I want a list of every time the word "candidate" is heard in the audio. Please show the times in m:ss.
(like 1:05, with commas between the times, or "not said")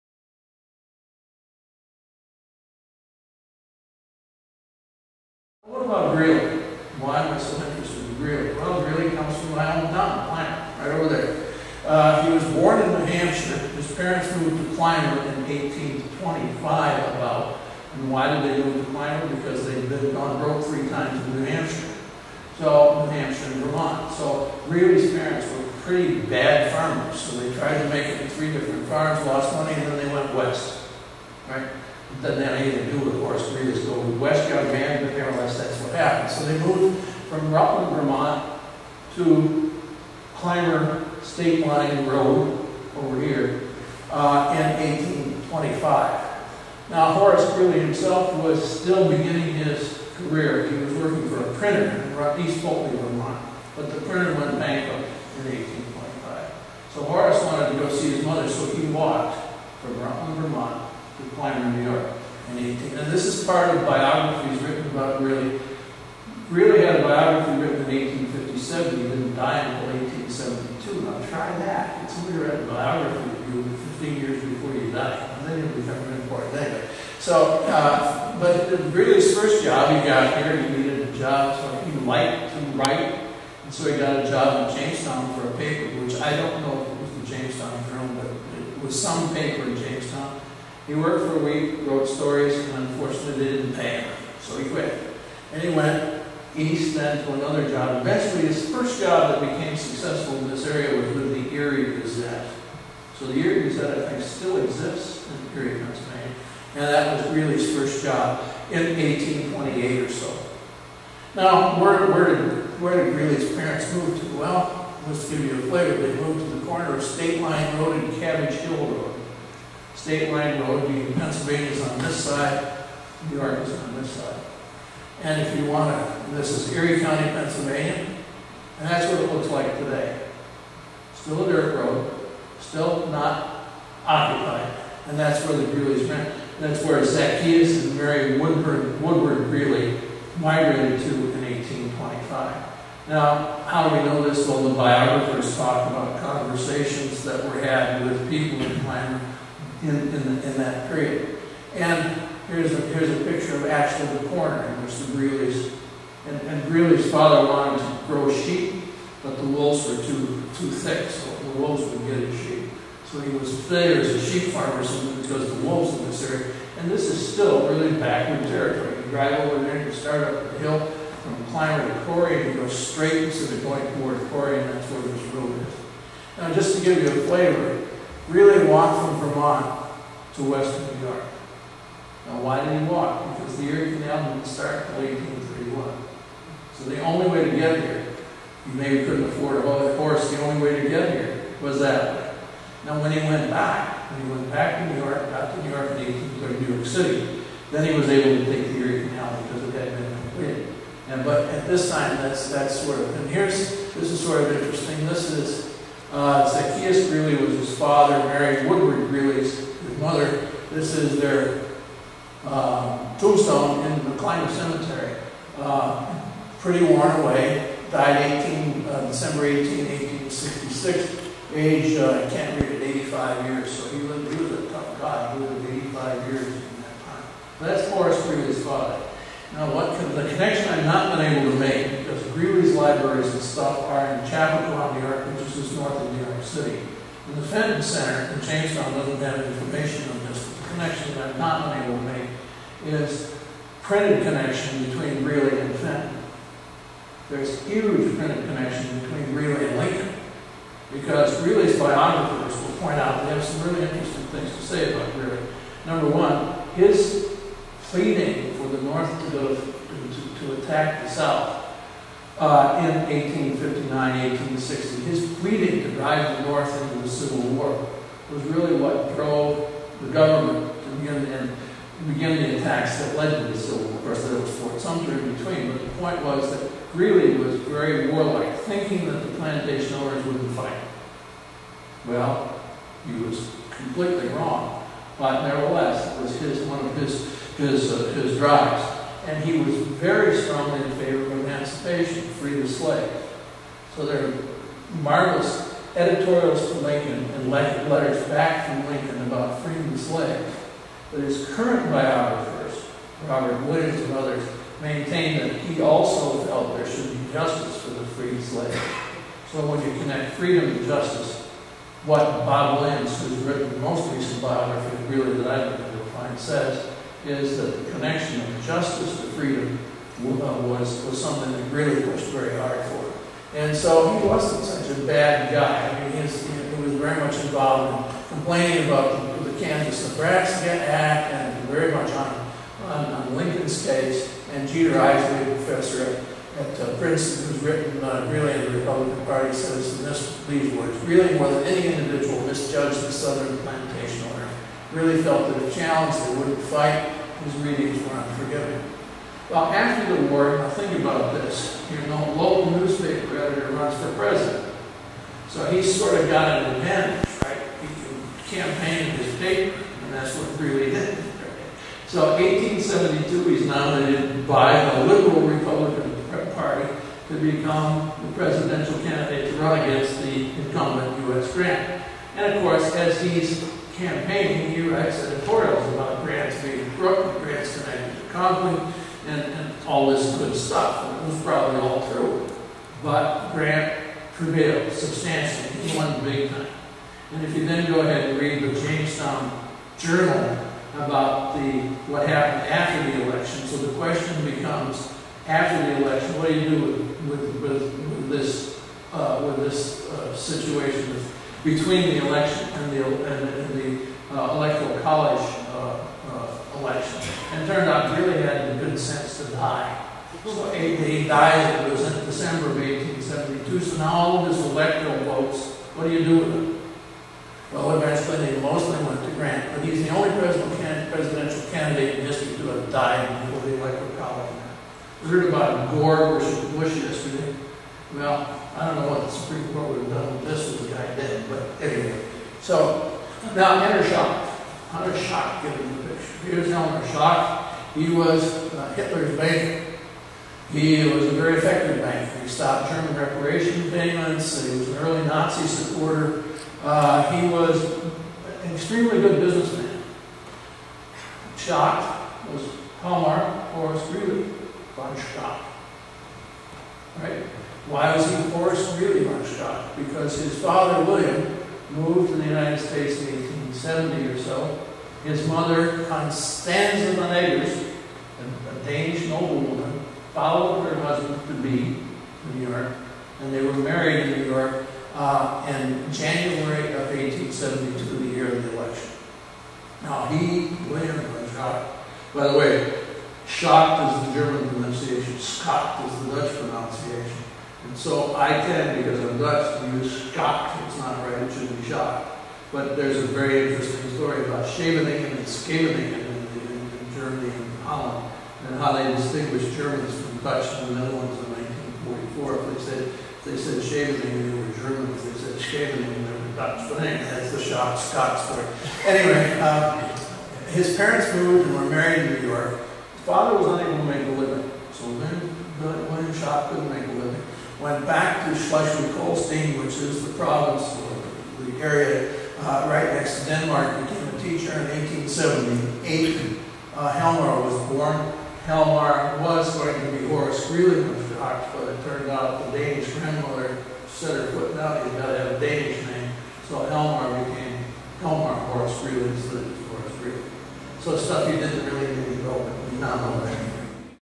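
6:08, 7:01.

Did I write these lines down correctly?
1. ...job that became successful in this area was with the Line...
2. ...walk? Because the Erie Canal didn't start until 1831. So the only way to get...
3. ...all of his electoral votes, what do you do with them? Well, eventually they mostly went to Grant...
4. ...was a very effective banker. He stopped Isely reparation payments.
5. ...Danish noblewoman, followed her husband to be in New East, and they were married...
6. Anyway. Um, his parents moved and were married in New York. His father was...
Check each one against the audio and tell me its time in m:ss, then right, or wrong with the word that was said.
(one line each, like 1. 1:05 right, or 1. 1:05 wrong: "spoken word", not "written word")
1. 1:39 wrong: "Erie", not "Line"
2. 3:02 right
3. 6:54 right
4. 7:21 wrong: "German", not "Isely"
5. 7:48 wrong: "York", not "East"
6. 8:29 right.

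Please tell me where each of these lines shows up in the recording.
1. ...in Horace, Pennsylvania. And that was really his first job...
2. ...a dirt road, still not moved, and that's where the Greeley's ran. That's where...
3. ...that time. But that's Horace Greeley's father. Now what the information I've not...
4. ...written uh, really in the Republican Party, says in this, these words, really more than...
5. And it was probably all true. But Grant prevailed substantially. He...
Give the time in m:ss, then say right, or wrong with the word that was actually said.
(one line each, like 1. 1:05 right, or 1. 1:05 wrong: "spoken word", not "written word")
1. 1:45 wrong: "Erie", not "Horace"
2. 2:11 wrong: "occupied", not "moved"
3. 3:46 wrong: "connection", not "information"
4. 5:37 right
5. 6:21 right.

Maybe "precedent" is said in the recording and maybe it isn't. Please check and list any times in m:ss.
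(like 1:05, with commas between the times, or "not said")
not said.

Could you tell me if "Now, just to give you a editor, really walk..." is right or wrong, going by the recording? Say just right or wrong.
wrong.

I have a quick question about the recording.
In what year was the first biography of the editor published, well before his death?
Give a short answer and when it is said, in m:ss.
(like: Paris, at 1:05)
1857, at 1:08.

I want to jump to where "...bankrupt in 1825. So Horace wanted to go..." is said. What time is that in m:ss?
0:54.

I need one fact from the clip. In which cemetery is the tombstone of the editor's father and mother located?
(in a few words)
McLean Cemetery.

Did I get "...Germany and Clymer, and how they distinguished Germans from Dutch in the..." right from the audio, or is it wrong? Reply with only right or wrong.
wrong.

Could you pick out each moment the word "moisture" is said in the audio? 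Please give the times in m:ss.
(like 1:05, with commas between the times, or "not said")
not said.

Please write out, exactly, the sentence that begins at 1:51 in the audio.
Now, where, where, did, where did Greeley's parents move to?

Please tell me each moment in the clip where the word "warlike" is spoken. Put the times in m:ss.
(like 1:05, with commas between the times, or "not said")
4:38.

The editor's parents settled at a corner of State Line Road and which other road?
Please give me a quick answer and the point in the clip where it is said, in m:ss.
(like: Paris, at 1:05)
Cabbage Hill Road, at 1:58.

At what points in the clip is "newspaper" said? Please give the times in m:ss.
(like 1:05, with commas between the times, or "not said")
5:52.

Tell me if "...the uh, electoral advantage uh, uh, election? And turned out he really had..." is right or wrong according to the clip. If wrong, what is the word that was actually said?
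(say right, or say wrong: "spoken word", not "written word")
wrong: "college", not "advantage".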